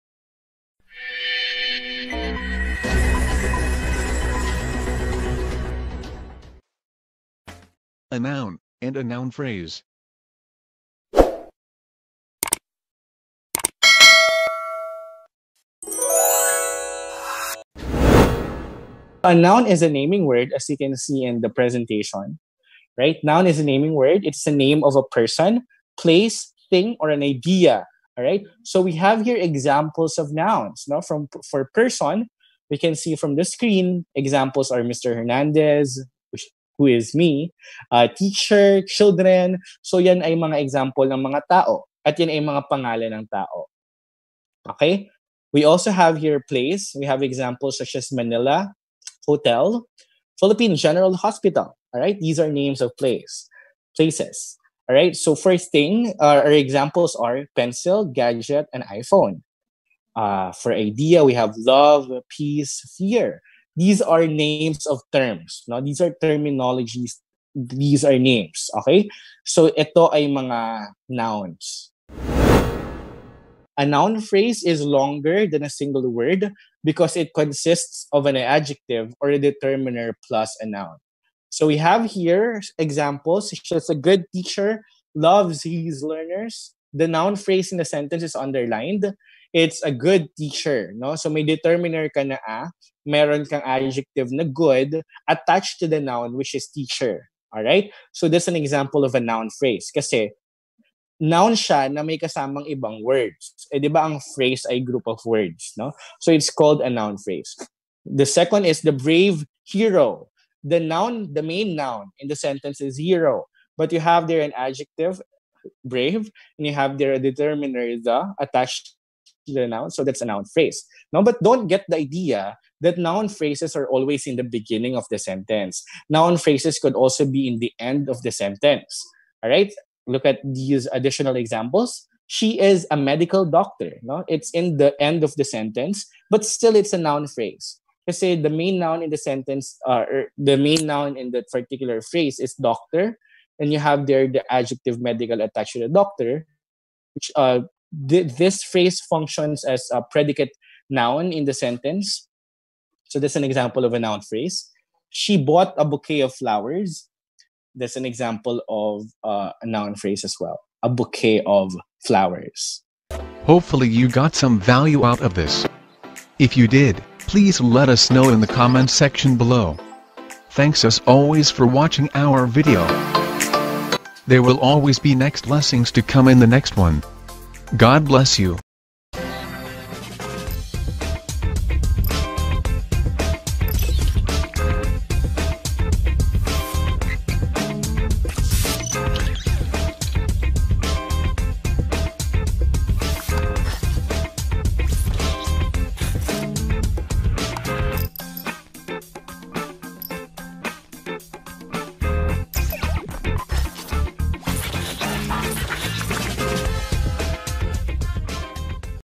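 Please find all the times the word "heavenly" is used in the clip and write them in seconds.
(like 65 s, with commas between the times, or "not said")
not said.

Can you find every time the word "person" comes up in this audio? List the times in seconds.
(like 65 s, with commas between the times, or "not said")
25 s, 31 s.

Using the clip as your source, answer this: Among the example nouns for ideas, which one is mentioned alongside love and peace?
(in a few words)
Fear.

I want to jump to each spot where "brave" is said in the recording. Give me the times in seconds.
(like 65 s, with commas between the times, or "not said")
108 s, 115 s.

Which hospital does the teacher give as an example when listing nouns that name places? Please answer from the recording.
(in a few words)
Philippine General Hospital.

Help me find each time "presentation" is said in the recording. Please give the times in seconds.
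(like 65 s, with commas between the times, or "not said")
21 s.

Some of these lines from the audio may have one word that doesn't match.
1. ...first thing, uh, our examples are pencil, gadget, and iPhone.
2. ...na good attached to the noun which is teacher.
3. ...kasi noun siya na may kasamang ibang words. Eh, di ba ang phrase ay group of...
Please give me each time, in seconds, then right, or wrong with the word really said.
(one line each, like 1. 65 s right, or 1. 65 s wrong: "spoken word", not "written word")
1. 55 s right
2. 94 s right
3. 99 s right.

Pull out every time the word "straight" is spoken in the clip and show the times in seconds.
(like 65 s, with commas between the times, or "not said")
not said.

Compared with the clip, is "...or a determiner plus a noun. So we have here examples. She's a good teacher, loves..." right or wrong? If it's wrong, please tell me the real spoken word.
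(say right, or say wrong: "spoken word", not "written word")
right.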